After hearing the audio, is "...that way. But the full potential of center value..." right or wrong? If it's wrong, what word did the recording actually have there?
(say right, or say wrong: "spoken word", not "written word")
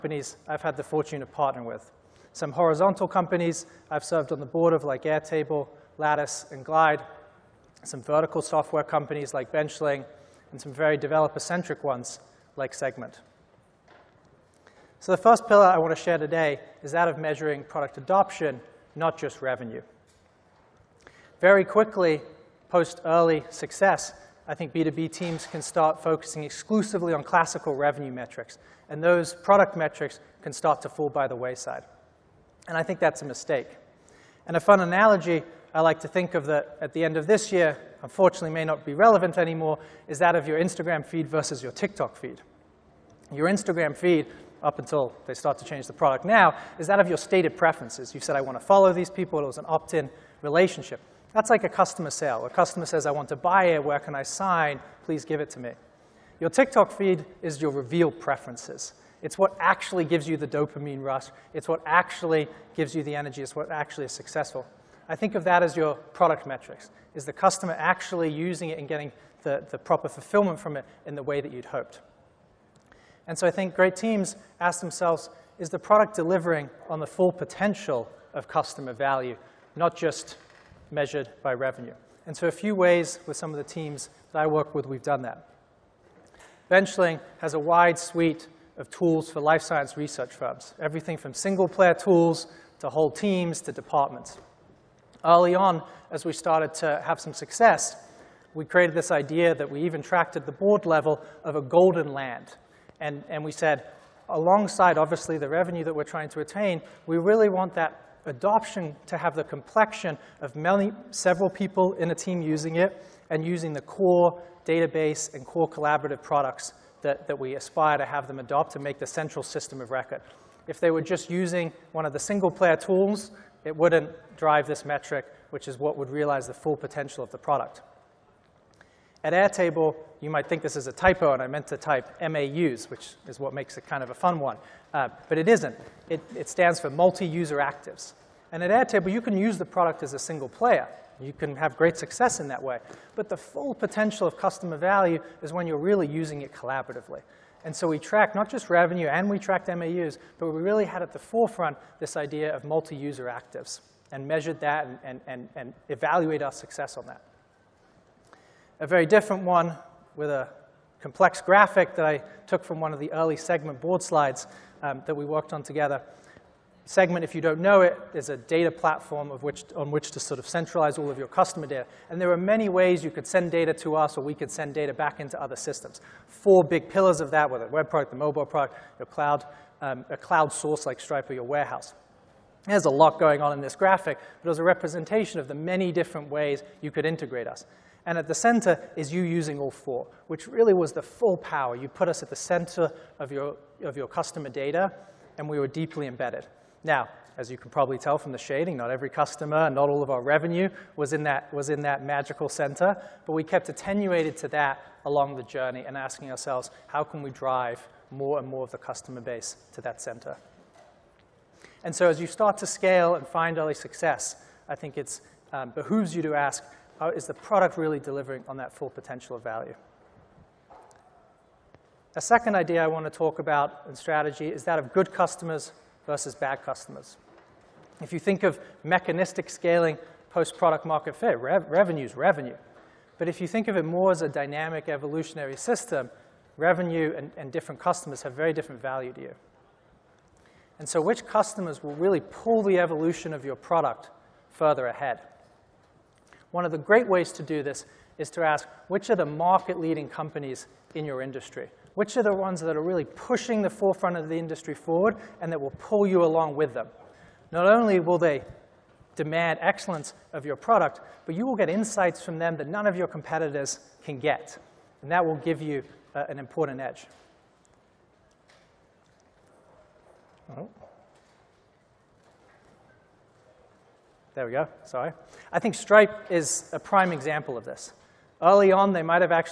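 wrong: "customer", not "center".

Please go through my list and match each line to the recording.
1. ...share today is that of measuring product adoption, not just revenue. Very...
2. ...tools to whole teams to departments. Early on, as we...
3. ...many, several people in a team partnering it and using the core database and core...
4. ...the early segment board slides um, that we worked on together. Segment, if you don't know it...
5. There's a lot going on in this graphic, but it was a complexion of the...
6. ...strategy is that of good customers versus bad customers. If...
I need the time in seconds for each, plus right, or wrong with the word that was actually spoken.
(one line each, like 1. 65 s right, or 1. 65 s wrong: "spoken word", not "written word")
1. 16 s right
2. 91 s right
3. 110 s wrong: "using", not "partnering"
4. 162 s right
5. 182 s wrong: "representation", not "complexion"
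6. 223 s right.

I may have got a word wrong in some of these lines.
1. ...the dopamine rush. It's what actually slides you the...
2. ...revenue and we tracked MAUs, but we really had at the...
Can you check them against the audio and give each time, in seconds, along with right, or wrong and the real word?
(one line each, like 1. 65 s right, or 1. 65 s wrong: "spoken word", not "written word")
1. 60 s wrong: "gives", not "slides"
2. 148 s right.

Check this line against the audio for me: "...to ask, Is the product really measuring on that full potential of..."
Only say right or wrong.
wrong.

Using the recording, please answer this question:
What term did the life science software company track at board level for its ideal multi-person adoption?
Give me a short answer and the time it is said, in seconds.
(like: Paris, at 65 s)
golden land, at 101 s.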